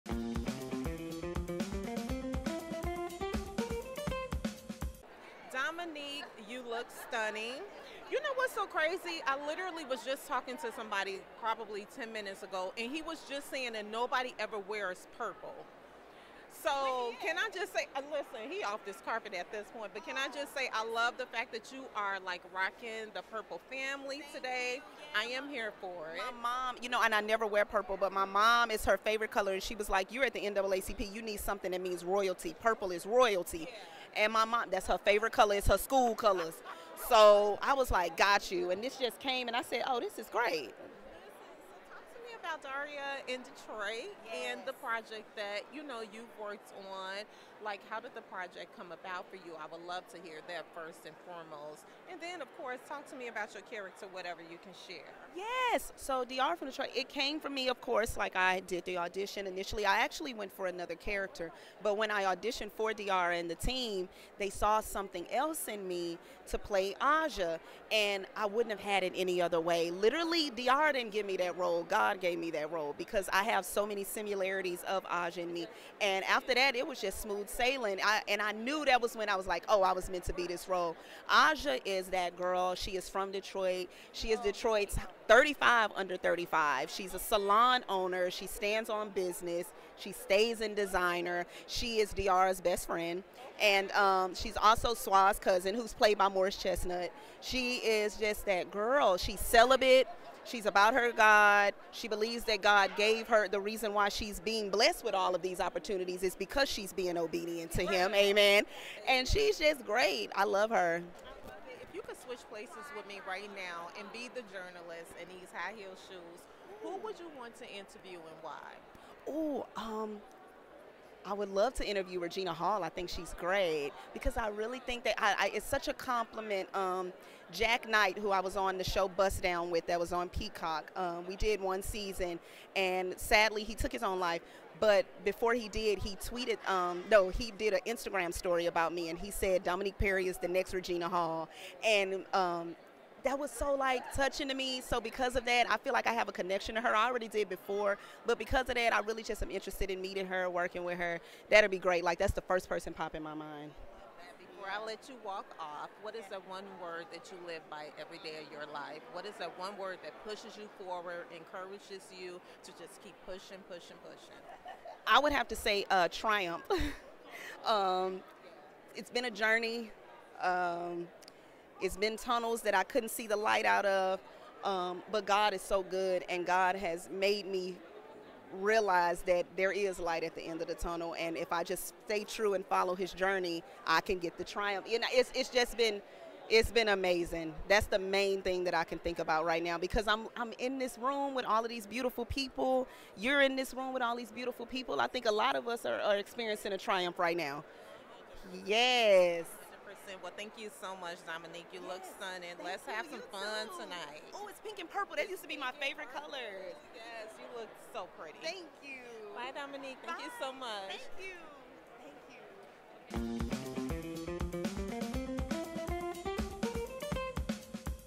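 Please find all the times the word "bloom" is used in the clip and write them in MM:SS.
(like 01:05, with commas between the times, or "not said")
not said.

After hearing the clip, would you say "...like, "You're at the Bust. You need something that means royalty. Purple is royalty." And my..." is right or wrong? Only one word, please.
wrong.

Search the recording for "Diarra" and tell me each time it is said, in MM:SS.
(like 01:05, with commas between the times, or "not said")
00:42, 00:56, 01:02, 01:10, 01:32.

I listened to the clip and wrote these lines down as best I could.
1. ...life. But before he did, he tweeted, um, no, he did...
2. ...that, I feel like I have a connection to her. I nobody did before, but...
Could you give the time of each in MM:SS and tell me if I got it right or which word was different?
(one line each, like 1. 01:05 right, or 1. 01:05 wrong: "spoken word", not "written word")
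1. 02:14 right
2. 02:25 wrong: "already", not "nobody".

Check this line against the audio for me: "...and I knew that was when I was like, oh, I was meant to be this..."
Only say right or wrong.
right.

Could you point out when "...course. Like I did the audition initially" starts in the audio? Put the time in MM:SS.
00:57.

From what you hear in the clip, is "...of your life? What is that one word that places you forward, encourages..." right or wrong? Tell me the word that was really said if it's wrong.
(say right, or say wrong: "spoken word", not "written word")
wrong: "pushes", not "places".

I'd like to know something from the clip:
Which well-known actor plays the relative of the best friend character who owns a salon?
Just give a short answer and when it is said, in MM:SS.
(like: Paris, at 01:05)
Morris Chestnut, at 01:36.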